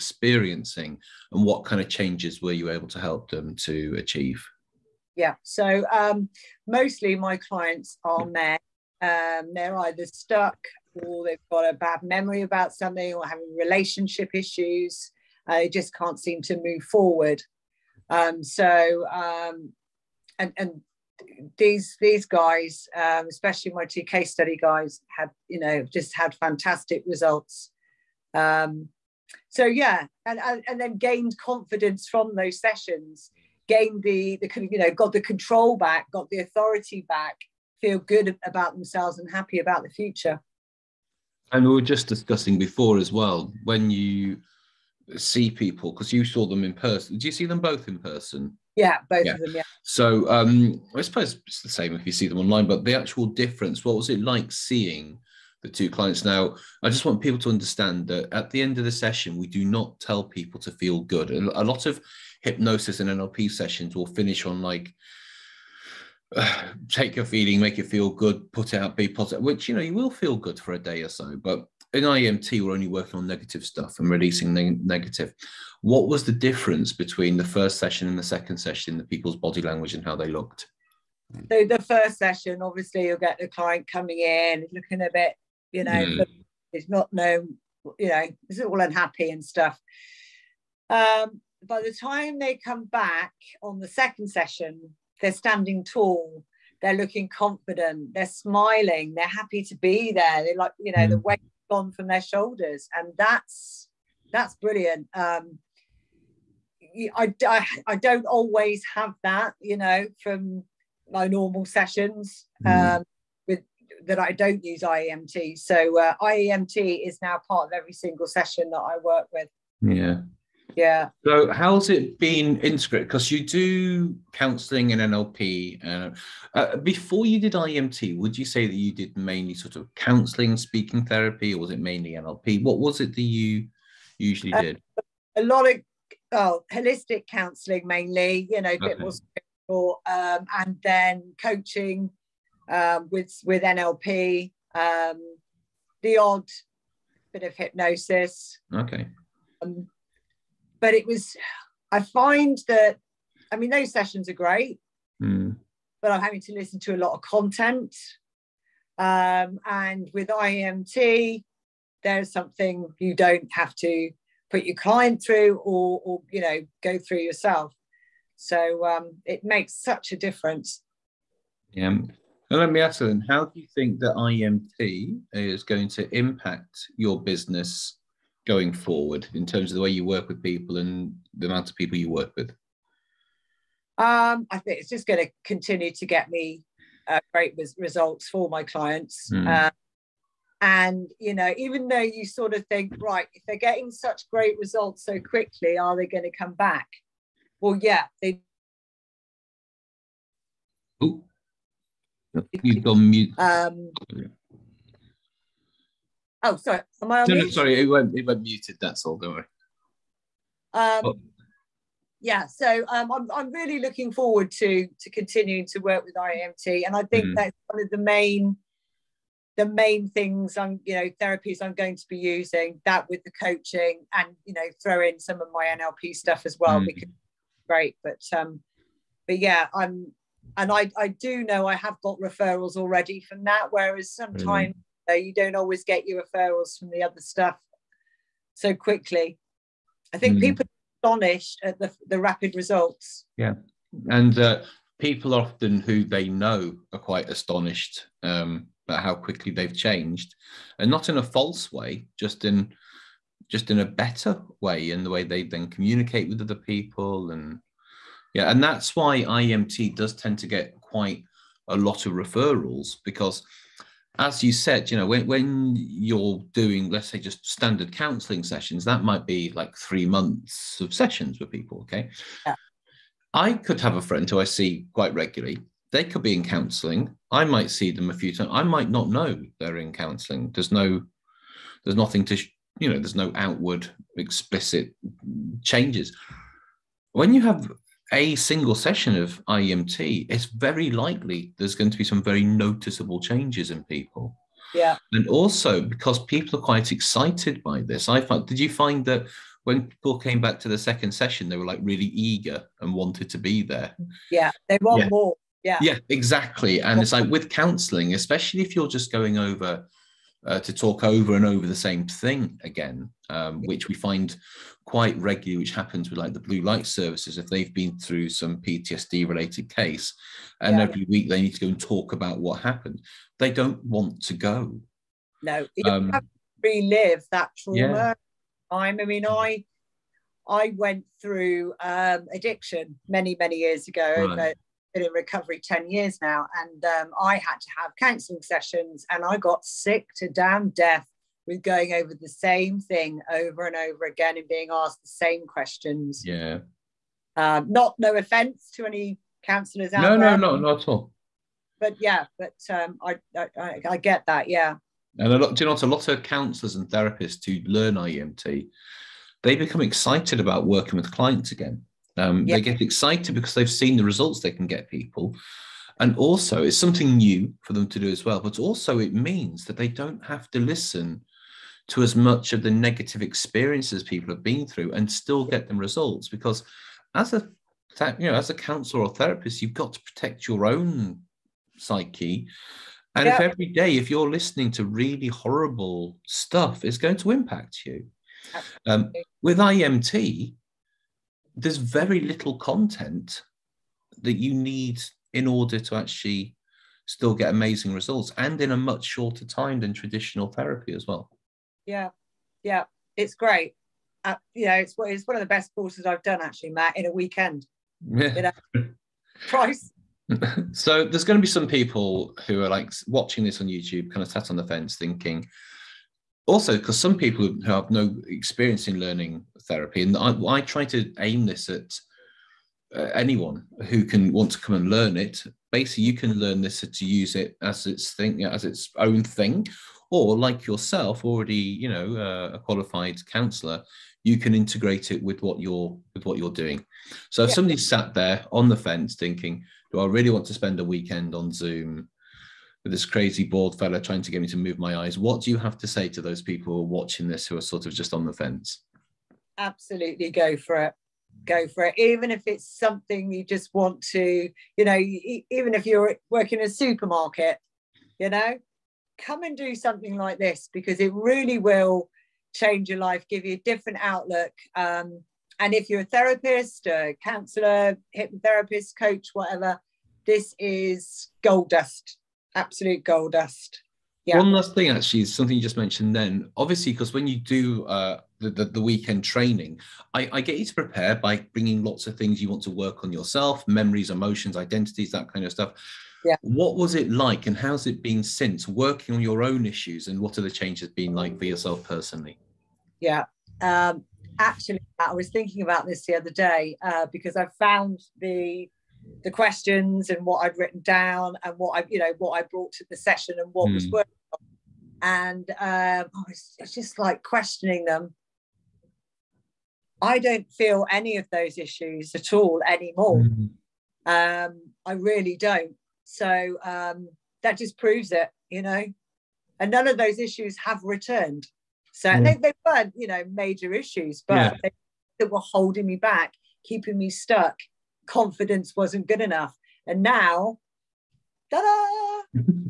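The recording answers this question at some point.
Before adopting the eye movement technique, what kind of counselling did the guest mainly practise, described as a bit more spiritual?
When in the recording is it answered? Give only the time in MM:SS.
02:16.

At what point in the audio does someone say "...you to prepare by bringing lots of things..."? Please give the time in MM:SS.
08:00.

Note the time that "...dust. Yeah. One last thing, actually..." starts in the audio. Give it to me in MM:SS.
07:53.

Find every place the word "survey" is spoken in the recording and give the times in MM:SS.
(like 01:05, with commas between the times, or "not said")
not said.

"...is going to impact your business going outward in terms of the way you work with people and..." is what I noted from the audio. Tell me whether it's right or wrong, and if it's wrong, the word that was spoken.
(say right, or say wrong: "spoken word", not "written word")
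wrong: "forward", not "outward".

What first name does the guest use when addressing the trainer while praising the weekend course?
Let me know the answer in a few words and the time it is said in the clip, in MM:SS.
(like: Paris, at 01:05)
Matt, at 06:46.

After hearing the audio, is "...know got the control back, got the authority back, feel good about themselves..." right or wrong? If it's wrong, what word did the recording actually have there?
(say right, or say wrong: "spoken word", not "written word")
right.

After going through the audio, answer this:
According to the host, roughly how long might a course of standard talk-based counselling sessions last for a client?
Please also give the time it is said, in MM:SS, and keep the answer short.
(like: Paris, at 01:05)
3 months, at 04:29.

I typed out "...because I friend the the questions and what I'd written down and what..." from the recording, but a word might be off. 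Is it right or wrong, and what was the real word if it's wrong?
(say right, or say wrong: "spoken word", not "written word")
wrong: "found", not "friend".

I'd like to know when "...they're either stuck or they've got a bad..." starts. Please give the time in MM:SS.
00:09.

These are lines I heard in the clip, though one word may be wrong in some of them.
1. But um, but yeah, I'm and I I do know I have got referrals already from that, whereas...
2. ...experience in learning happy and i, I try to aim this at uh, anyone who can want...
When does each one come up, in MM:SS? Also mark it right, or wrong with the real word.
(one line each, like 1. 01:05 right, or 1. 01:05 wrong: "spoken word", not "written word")
1. 03:48 right
2. 06:58 wrong: "therapy", not "happy".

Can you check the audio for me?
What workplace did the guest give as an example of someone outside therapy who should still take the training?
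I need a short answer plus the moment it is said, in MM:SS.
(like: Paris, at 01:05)
Supermarket, at 07:36.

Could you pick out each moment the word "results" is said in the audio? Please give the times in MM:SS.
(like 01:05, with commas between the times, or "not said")
00:27, 03:07, 03:14, 04:02, 06:04, 06:15, 06:37.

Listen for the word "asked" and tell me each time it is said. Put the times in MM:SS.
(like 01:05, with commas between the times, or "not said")
05:44.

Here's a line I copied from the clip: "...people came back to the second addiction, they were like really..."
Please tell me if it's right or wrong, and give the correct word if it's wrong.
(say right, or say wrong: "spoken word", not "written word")
wrong: "session", not "addiction".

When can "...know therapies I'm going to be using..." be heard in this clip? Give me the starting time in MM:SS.
03:40.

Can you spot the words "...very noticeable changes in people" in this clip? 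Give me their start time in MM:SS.
04:52.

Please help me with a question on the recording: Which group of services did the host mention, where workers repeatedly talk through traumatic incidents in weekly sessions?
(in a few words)
Blue light services.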